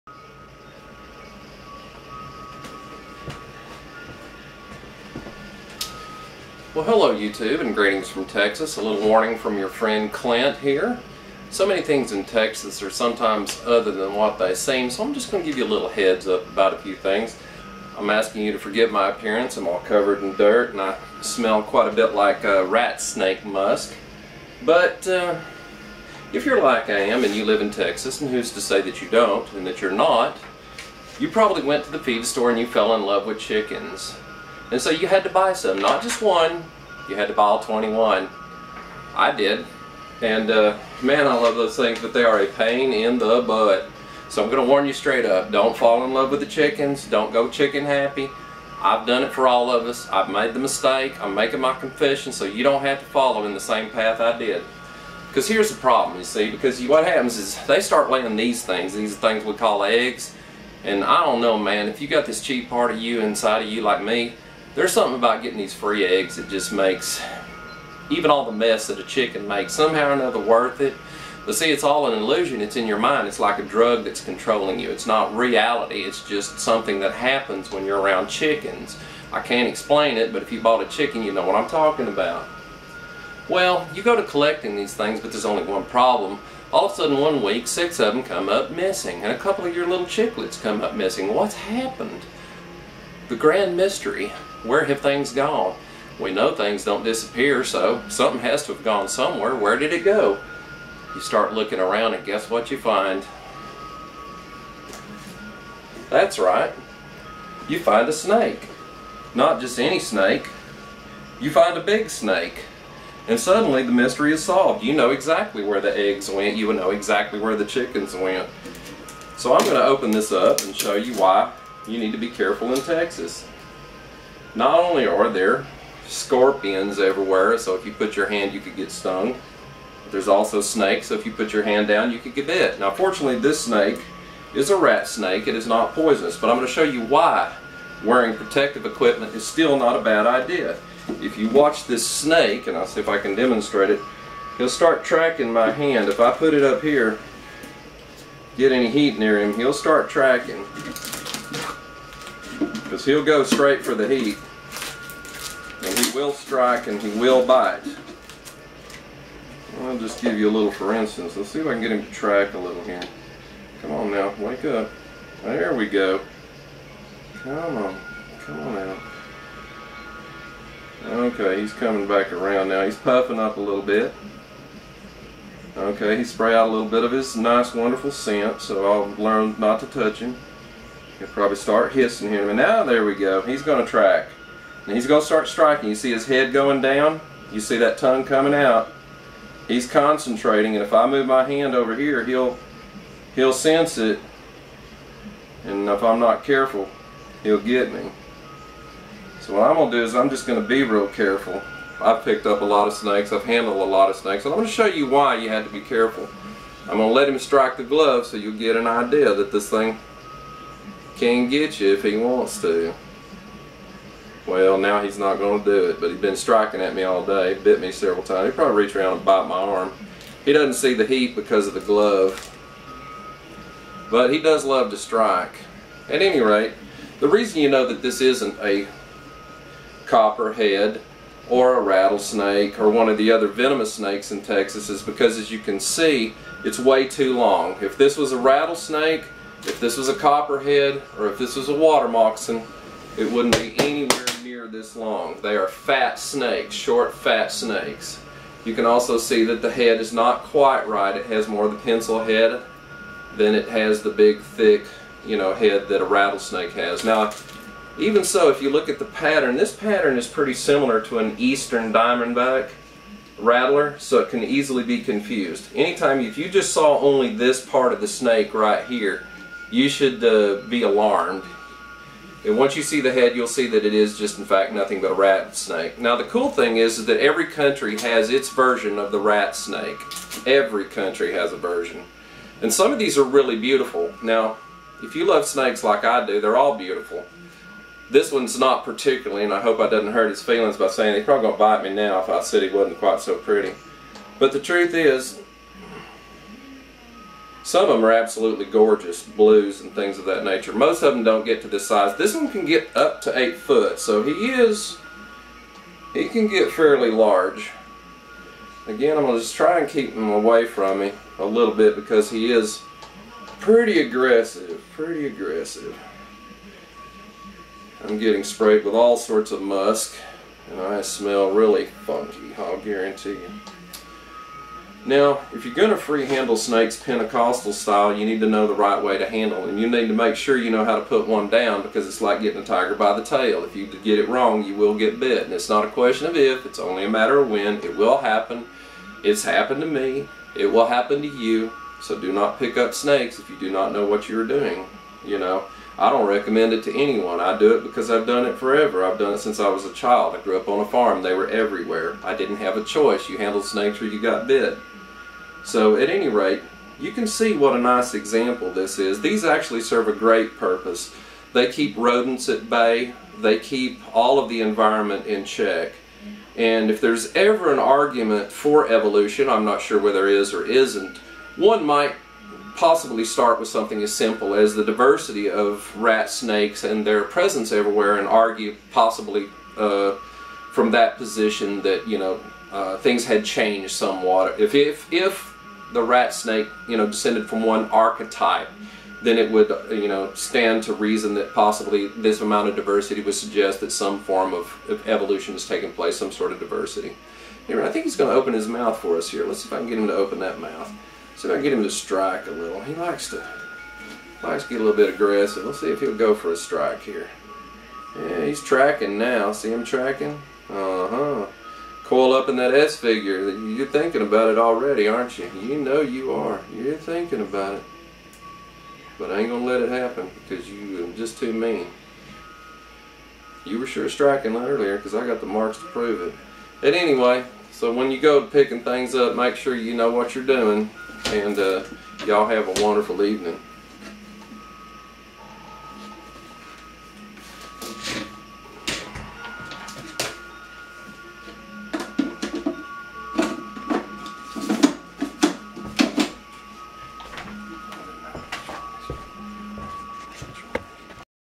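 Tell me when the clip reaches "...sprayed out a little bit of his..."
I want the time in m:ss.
2:56.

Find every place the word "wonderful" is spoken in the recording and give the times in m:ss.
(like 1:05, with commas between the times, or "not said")
2:57, 7:12.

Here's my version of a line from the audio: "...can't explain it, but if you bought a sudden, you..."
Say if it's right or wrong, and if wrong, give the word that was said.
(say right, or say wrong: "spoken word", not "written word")
wrong: "chicken", not "sudden".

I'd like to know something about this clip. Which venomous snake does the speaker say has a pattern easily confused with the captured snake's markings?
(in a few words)
eastern diamondback rattler.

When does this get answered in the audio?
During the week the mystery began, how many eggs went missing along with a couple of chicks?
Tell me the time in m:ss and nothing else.
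1:27.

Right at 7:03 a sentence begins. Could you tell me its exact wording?
You were sure striking earlier because I got the marks to prove it.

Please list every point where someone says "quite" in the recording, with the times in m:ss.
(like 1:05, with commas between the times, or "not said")
0:21, 4:10, 4:52.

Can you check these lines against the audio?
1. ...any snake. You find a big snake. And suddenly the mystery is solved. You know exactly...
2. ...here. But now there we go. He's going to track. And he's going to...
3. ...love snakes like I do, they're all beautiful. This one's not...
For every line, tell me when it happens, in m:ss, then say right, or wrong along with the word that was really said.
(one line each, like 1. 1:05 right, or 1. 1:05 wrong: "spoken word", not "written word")
1. 1:49 right
2. 3:02 right
3. 4:45 right.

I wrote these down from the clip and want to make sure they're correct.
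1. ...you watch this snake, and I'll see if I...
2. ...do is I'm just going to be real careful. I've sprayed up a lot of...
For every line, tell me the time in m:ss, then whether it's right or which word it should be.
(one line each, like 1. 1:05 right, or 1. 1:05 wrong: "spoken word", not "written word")
1. 2:21 right
2. 3:19 wrong: "picked", not "sprayed".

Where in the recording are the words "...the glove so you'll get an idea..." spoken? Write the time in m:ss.
3:27.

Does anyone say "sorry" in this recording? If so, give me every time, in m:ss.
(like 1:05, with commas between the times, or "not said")
not said.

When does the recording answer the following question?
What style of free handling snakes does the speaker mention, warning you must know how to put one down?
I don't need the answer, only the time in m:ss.
5:27.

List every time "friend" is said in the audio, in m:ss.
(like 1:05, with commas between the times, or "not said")
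0:09.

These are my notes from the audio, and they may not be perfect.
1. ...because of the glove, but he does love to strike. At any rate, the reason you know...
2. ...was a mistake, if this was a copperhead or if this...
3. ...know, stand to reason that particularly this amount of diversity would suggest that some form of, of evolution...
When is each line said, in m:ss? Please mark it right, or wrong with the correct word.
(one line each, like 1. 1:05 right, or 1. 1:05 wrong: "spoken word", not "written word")
1. 3:41 right
2. 3:58 wrong: "rattlesnake", not "mistake"
3. 6:30 wrong: "possibly", not "particularly".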